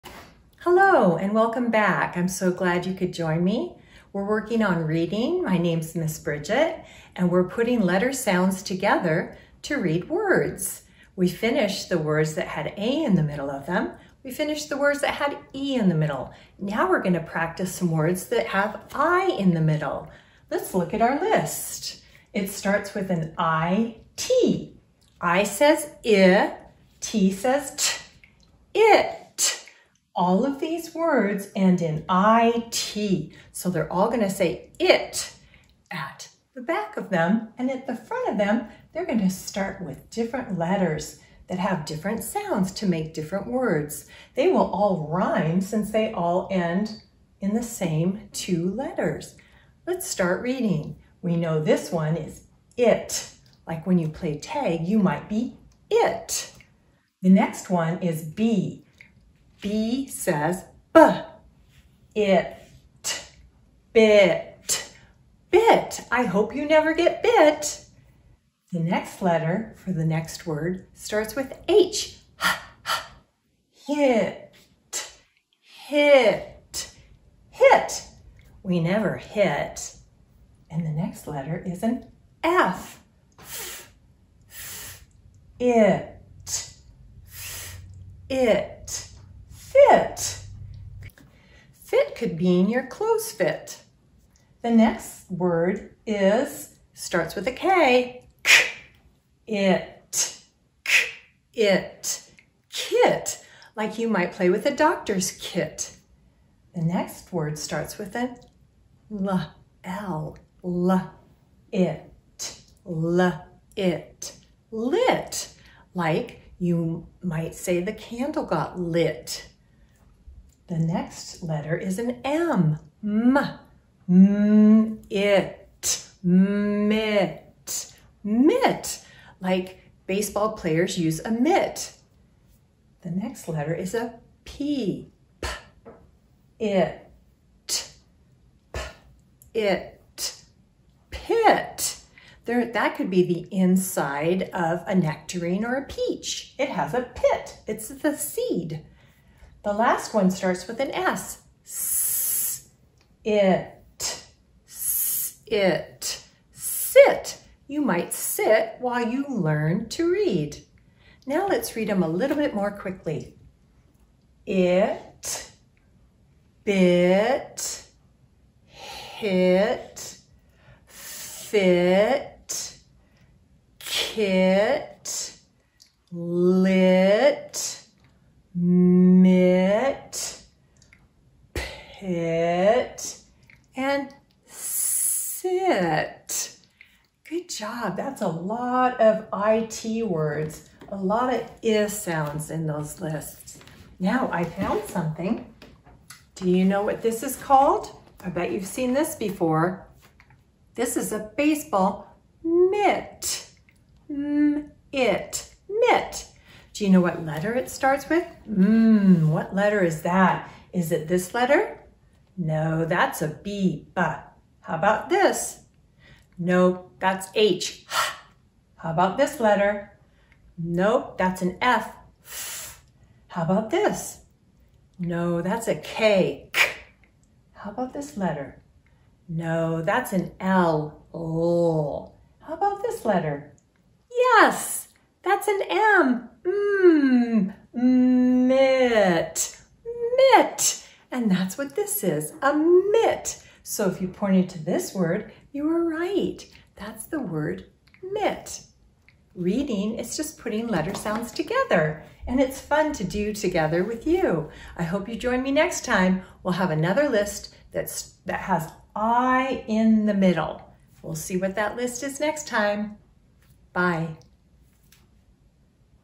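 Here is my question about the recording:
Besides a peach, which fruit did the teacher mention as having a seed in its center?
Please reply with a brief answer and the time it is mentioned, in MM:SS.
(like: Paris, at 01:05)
nectarine, at 02:24.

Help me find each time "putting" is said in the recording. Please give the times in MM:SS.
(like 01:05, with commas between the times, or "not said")
00:07, 04:10.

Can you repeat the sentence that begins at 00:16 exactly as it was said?
Now we're gonna practice some words that have I in the middle.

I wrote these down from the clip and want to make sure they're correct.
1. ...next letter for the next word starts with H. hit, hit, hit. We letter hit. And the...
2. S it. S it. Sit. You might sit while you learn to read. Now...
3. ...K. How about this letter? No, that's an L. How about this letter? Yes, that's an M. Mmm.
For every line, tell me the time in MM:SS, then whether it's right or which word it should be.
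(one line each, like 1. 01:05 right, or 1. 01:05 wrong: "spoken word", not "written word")
1. 01:08 wrong: "never", not "letter"
2. 02:31 right
3. 03:45 right.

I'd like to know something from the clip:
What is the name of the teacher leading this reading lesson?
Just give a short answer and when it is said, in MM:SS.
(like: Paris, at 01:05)
Miss Bridget, at 00:05.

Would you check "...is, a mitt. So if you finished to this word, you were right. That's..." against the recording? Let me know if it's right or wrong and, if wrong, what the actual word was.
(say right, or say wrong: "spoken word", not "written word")
wrong: "pointed", not "finished".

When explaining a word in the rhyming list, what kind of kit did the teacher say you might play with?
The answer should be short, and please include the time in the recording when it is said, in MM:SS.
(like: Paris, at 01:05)
doctor's kit, at 01:44.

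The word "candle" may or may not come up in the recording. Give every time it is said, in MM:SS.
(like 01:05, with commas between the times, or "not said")
01:57.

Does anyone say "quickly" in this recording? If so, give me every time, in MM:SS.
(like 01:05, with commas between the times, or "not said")
02:42.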